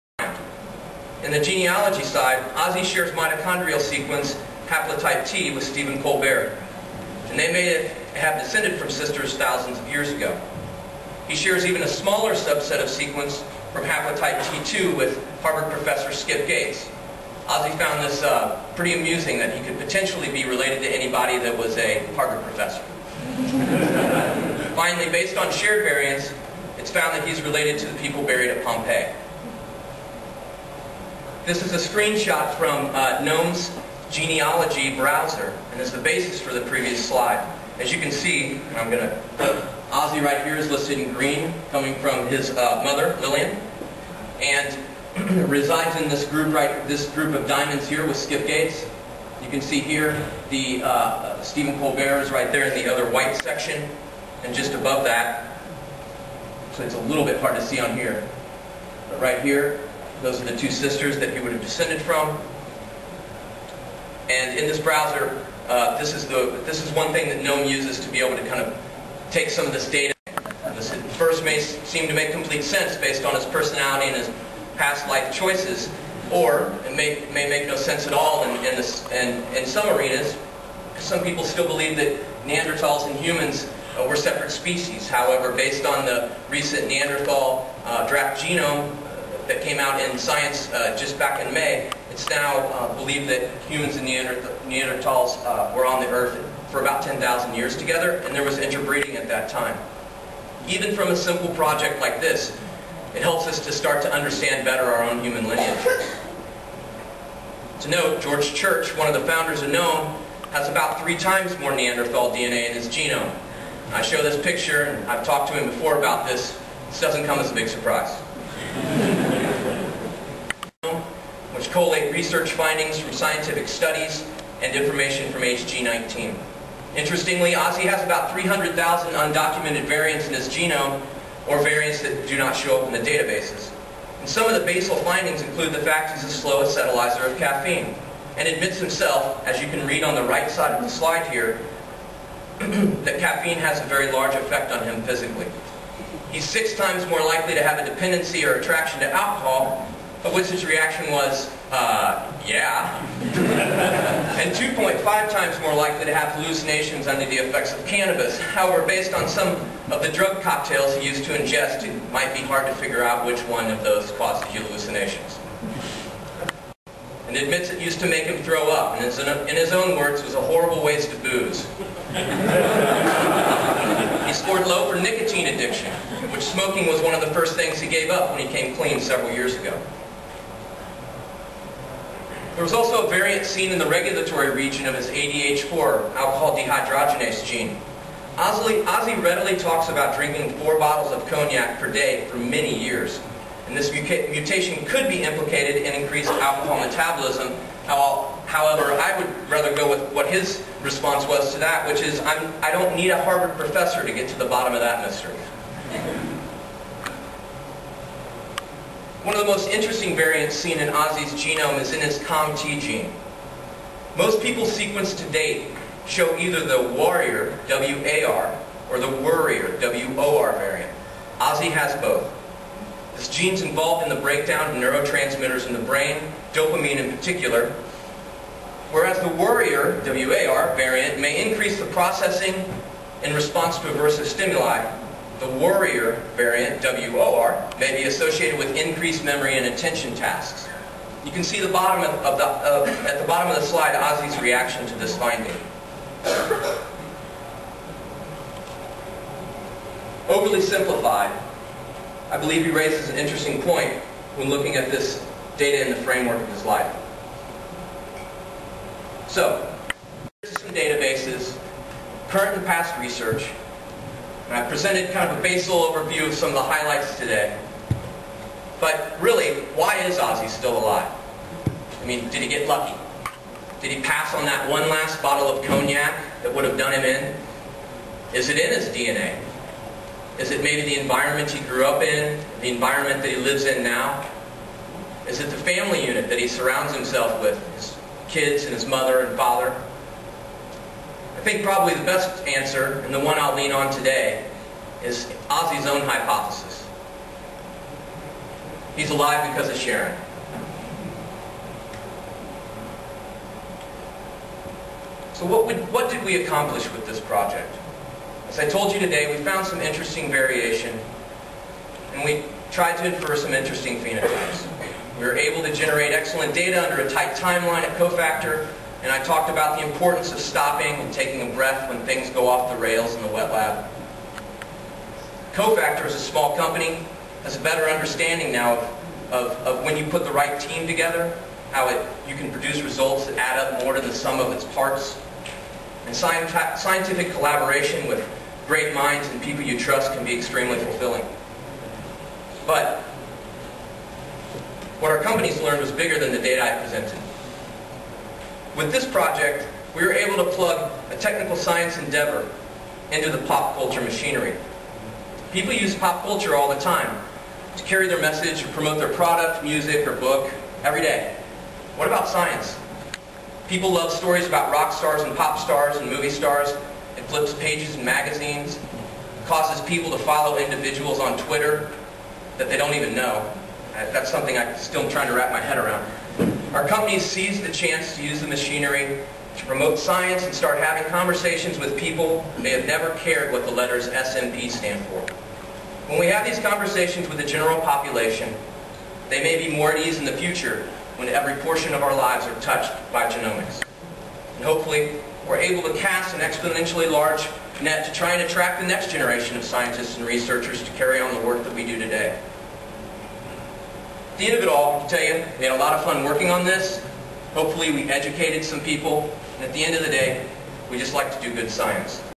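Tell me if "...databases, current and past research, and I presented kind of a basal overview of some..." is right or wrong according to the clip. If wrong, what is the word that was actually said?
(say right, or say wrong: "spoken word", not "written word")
right.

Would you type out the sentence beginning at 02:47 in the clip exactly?
And admits it used to make him throw up, and in his own words, was a horrible waste of booze.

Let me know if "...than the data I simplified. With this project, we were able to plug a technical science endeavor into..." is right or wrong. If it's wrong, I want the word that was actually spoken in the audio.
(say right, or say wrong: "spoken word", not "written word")
wrong: "presented", not "simplified".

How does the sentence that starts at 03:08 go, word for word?
Ozzy, Ozzy readily talks about drinking four bottles of cognac per day for many years.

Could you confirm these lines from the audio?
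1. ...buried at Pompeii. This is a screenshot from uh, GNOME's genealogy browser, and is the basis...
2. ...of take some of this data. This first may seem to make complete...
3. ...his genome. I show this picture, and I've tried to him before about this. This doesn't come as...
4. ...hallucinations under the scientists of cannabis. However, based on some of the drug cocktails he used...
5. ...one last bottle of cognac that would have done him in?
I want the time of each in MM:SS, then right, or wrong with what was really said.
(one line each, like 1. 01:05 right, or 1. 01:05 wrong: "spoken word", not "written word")
1. 00:28 right
2. 01:08 right
3. 01:52 wrong: "talked", not "tried"
4. 02:36 wrong: "effects", not "scientists"
5. 04:34 right.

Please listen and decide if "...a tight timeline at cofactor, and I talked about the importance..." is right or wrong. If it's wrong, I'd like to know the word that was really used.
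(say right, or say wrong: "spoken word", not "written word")
right.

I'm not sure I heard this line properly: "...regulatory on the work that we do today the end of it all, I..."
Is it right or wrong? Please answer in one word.
wrong.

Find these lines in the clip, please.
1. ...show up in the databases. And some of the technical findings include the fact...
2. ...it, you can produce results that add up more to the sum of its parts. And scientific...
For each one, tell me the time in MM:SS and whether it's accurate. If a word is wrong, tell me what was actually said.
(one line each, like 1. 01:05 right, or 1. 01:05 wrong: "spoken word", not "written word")
1. 02:12 wrong: "basal", not "technical"
2. 05:31 right.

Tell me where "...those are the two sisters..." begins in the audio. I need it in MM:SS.
01:00.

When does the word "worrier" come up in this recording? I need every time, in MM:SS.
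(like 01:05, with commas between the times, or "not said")
03:39, 03:49.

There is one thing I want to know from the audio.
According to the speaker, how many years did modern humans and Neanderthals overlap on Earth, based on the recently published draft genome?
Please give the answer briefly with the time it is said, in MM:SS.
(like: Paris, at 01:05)
10,000 years, at 01:37.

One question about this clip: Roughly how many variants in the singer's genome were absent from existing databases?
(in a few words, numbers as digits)
300,000.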